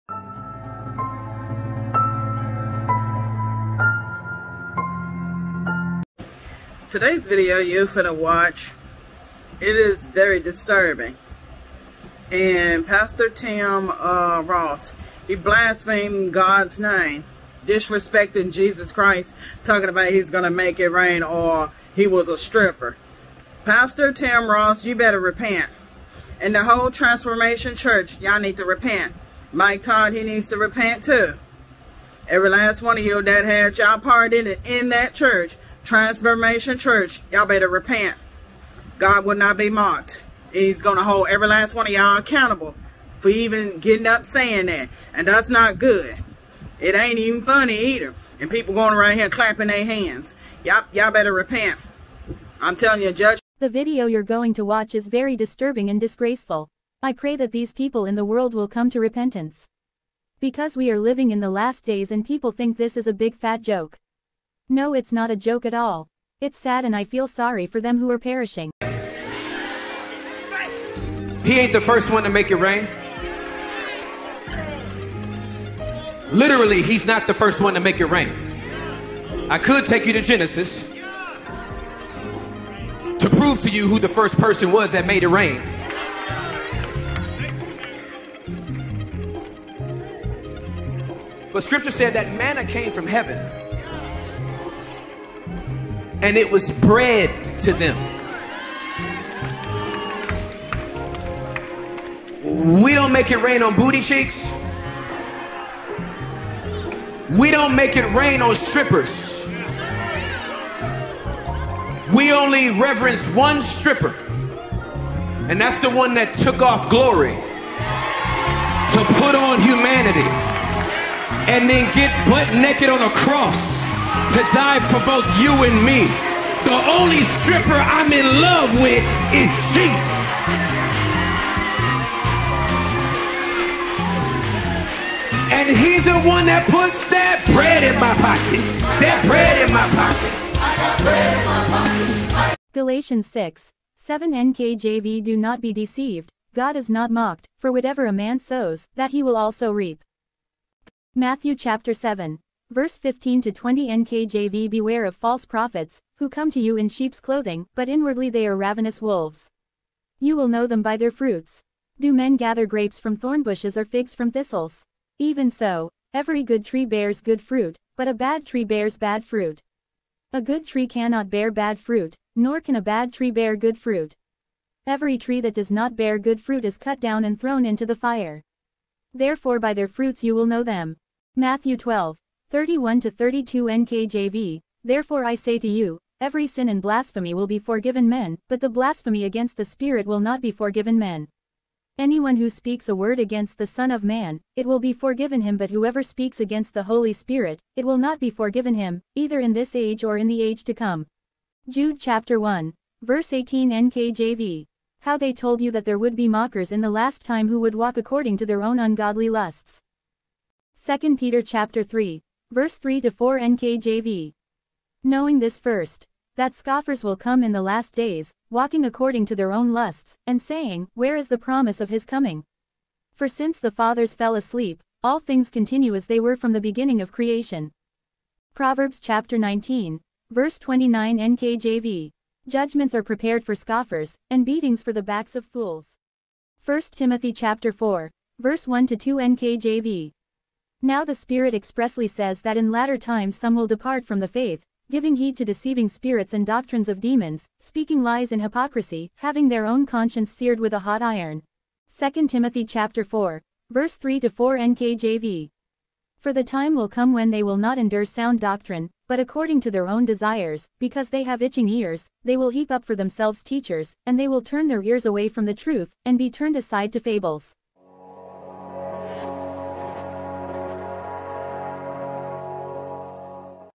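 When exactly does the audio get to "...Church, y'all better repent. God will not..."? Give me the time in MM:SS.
00:36.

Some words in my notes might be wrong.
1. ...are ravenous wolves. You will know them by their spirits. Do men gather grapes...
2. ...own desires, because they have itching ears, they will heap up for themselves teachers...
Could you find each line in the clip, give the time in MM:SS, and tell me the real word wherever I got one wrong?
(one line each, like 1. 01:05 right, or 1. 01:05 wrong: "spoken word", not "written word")
1. 02:38 wrong: "fruits", not "spirits"
2. 04:19 right.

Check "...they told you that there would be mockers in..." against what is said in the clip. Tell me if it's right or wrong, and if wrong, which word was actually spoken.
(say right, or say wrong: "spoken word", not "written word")
right.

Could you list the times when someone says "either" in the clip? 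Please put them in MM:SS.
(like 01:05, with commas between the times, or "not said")
00:47, 03:19.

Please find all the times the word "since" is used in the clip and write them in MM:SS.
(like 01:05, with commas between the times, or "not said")
03:43.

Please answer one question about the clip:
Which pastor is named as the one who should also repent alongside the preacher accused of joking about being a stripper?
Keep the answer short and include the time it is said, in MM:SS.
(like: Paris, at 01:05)
Mike Todd, at 00:29.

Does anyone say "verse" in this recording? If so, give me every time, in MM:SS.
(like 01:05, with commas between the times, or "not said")
02:32, 03:23, 03:32, 03:50, 03:58, 04:13.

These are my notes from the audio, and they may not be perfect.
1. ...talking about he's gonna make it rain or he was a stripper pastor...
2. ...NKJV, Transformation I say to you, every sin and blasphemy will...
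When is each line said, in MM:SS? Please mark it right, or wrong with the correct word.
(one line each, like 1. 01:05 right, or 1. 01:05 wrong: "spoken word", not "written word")
1. 00:19 right
2. 03:03 wrong: "Therefore", not "Transformation".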